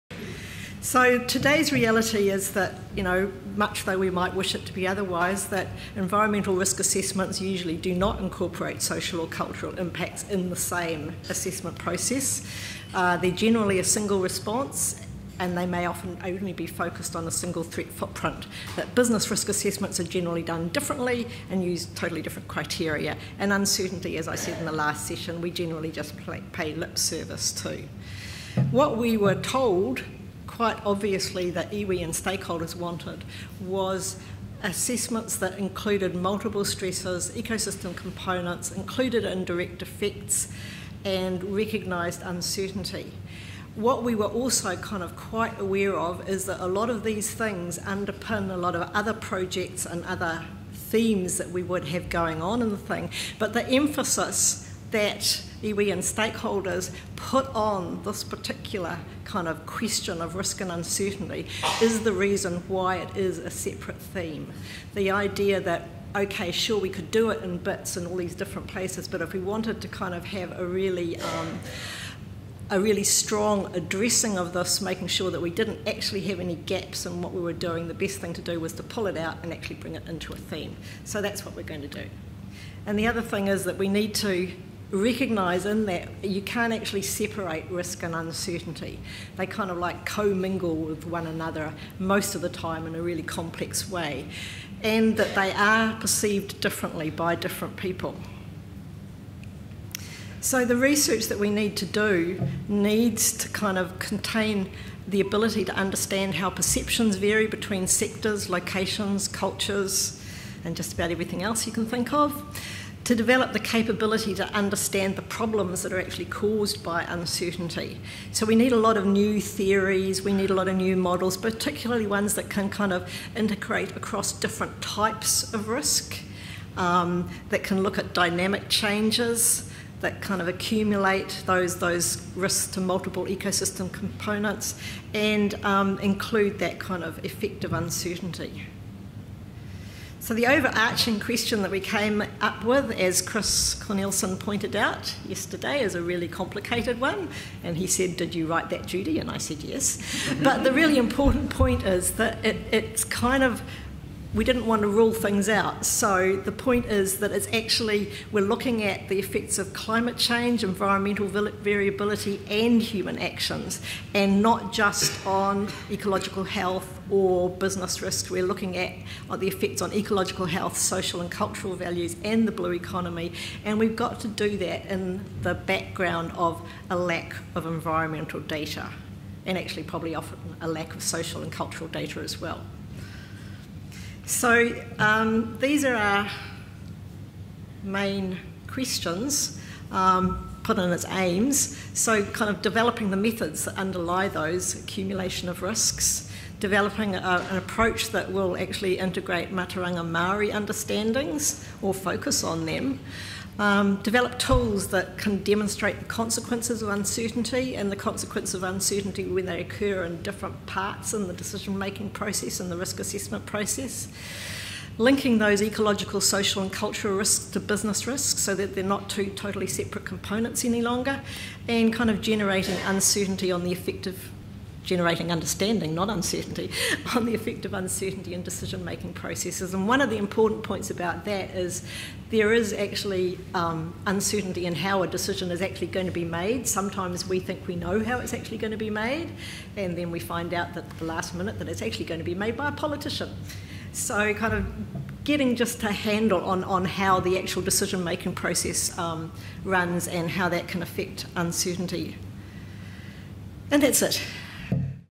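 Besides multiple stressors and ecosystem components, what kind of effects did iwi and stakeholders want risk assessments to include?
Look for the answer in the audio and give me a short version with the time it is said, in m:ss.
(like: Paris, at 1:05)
Indirect effects, at 0:39.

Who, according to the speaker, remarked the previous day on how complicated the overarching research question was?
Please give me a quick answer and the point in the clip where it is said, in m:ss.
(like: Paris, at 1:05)
Chris Cornelisen, at 2:23.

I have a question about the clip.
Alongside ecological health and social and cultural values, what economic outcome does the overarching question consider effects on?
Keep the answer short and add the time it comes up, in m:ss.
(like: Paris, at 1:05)
The blue economy, at 2:52.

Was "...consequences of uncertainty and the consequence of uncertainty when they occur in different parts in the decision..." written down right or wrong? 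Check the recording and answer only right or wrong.
right.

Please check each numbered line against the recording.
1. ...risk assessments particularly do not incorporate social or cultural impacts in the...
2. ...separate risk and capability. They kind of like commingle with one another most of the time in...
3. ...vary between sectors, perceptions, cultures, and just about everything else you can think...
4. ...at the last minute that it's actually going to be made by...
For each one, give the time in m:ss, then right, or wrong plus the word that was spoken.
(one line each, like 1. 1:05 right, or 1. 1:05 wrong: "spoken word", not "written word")
1. 0:06 wrong: "usually", not "particularly"
2. 1:27 wrong: "uncertainty", not "capability"
3. 1:47 wrong: "locations", not "perceptions"
4. 4:00 right.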